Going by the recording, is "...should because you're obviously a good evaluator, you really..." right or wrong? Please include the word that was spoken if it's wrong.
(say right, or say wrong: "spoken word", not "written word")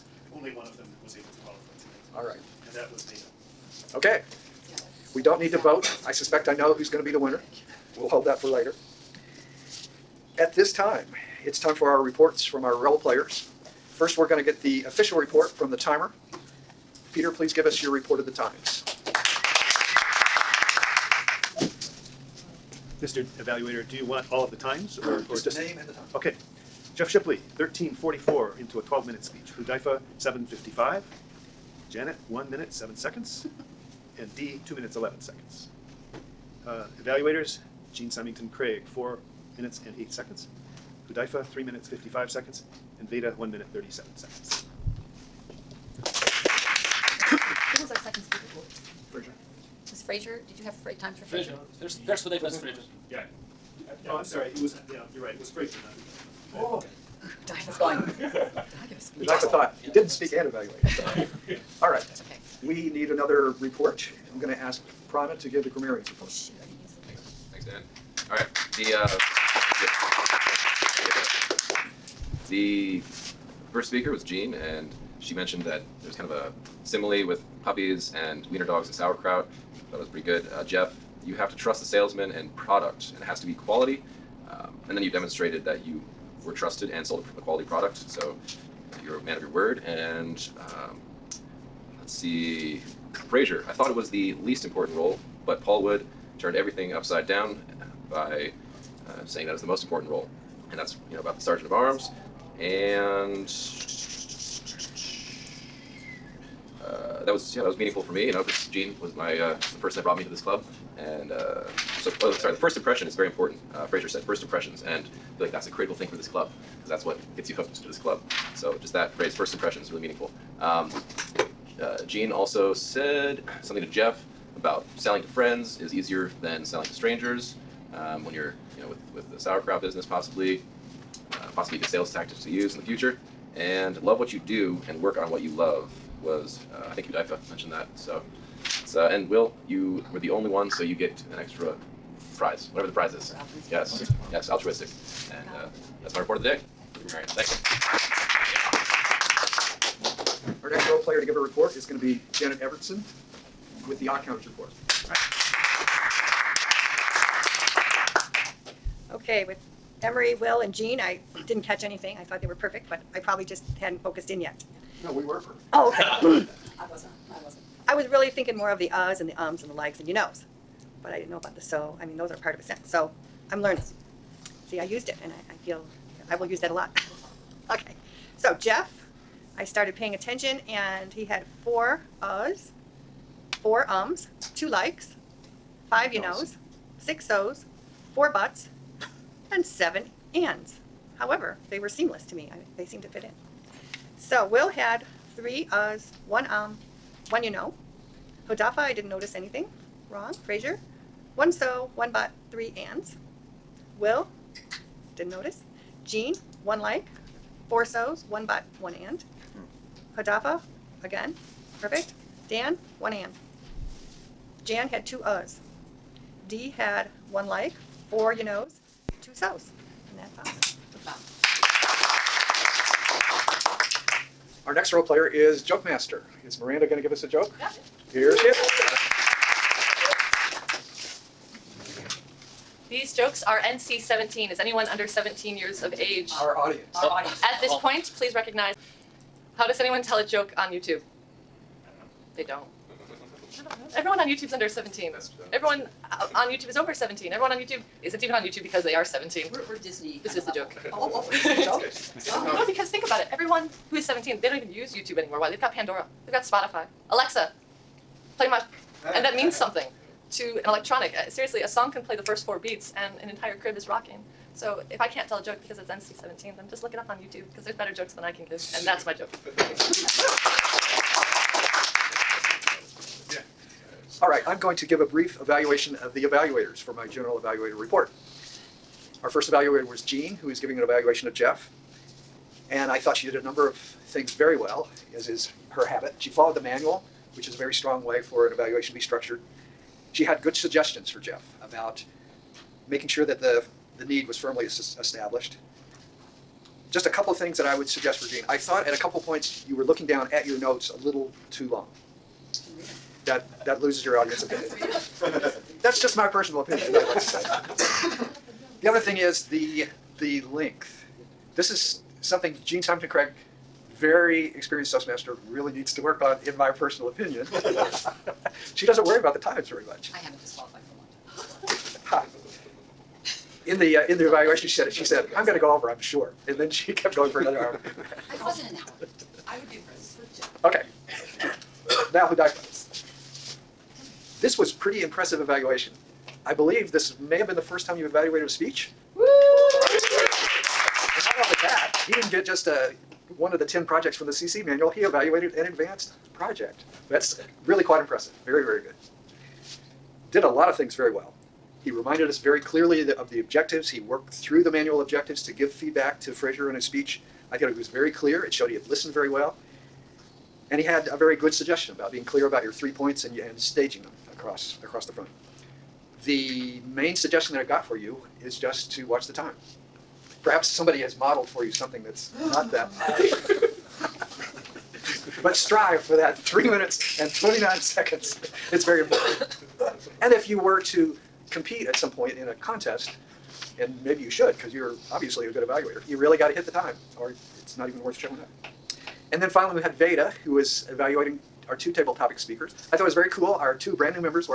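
right.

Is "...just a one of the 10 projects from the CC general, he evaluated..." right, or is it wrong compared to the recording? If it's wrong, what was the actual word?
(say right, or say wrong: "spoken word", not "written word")
wrong: "manual", not "general".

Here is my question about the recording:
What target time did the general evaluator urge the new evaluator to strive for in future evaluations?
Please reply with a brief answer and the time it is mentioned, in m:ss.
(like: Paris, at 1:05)
3 minutes 29 seconds, at 6:16.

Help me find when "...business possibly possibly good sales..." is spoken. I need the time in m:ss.
2:09.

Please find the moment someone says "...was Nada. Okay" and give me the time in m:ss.
0:02.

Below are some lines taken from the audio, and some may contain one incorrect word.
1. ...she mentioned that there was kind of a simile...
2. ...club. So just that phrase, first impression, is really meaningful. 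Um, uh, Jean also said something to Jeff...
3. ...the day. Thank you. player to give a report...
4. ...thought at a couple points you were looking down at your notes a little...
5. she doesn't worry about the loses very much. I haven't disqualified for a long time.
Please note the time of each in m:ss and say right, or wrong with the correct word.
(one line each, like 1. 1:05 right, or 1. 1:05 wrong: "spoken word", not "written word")
1. 1:15 right
2. 1:57 right
3. 2:26 right
4. 4:58 right
5. 5:18 wrong: "times", not "loses".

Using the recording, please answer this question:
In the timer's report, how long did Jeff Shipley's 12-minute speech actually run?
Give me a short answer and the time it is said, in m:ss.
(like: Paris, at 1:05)
13:44, at 0:27.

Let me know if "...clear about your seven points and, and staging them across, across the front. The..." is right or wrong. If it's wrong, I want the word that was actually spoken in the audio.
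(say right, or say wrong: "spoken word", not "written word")
wrong: "three", not "seven".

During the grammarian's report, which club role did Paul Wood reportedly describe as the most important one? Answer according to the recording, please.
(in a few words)
Sergeant of Arms.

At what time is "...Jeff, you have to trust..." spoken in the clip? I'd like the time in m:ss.
1:20.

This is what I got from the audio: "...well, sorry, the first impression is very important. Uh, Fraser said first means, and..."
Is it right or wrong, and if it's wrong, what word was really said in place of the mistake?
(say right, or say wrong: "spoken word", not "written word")
wrong: "impressions", not "means".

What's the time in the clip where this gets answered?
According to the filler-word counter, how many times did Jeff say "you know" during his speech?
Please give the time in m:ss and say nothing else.
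3:05.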